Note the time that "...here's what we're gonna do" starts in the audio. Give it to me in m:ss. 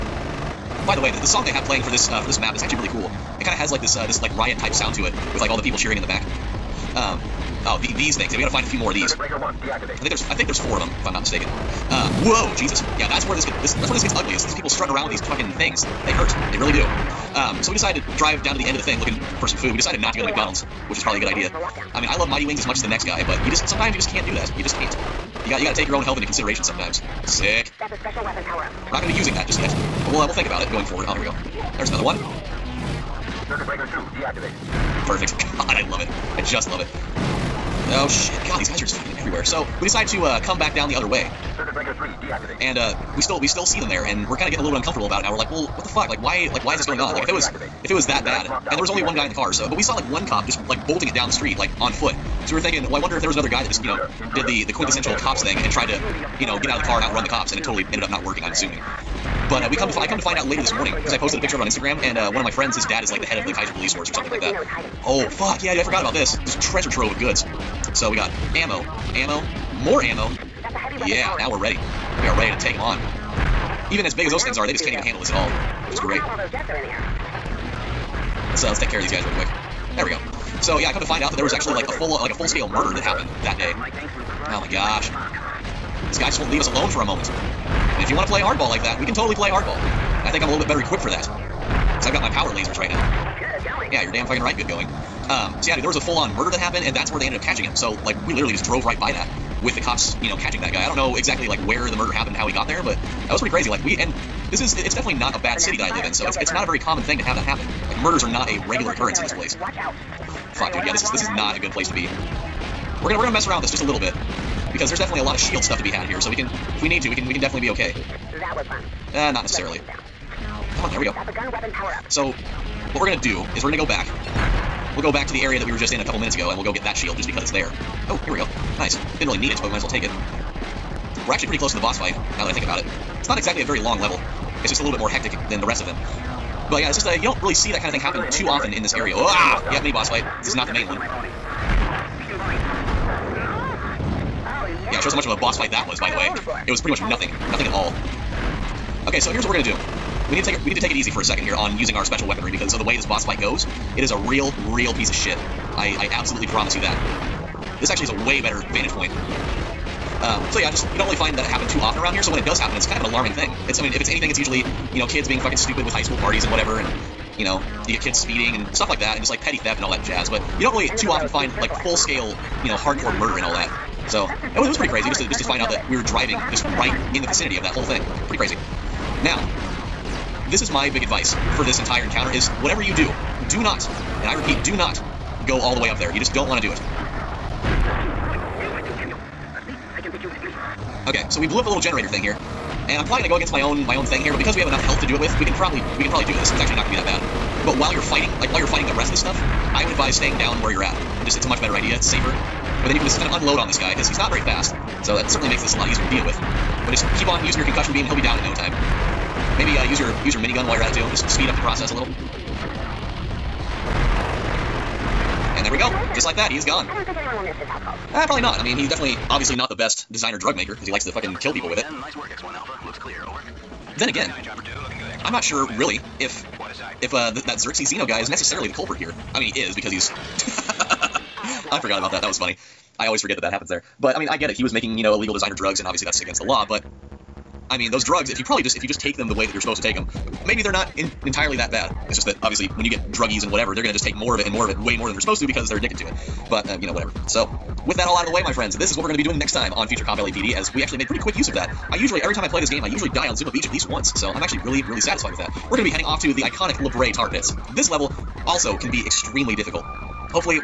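2:29.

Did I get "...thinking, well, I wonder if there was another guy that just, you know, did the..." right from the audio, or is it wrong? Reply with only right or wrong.
right.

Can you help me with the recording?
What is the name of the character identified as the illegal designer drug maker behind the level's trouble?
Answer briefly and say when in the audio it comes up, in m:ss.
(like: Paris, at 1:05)
Xerxes Zeno, at 3:47.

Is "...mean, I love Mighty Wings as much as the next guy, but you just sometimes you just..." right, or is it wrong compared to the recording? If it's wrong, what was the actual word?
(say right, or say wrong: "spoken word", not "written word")
right.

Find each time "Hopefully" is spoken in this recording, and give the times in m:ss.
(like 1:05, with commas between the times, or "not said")
4:19.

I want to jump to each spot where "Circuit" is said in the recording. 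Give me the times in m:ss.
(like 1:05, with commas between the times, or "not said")
0:33, 0:41.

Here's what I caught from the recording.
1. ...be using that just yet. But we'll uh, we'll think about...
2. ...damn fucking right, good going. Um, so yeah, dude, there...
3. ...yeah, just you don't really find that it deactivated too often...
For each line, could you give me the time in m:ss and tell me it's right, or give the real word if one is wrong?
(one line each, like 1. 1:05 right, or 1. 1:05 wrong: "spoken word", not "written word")
1. 0:29 right
2. 1:34 right
3. 2:40 wrong: "happened", not "deactivated".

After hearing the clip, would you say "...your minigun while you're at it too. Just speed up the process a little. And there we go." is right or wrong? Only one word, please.
right.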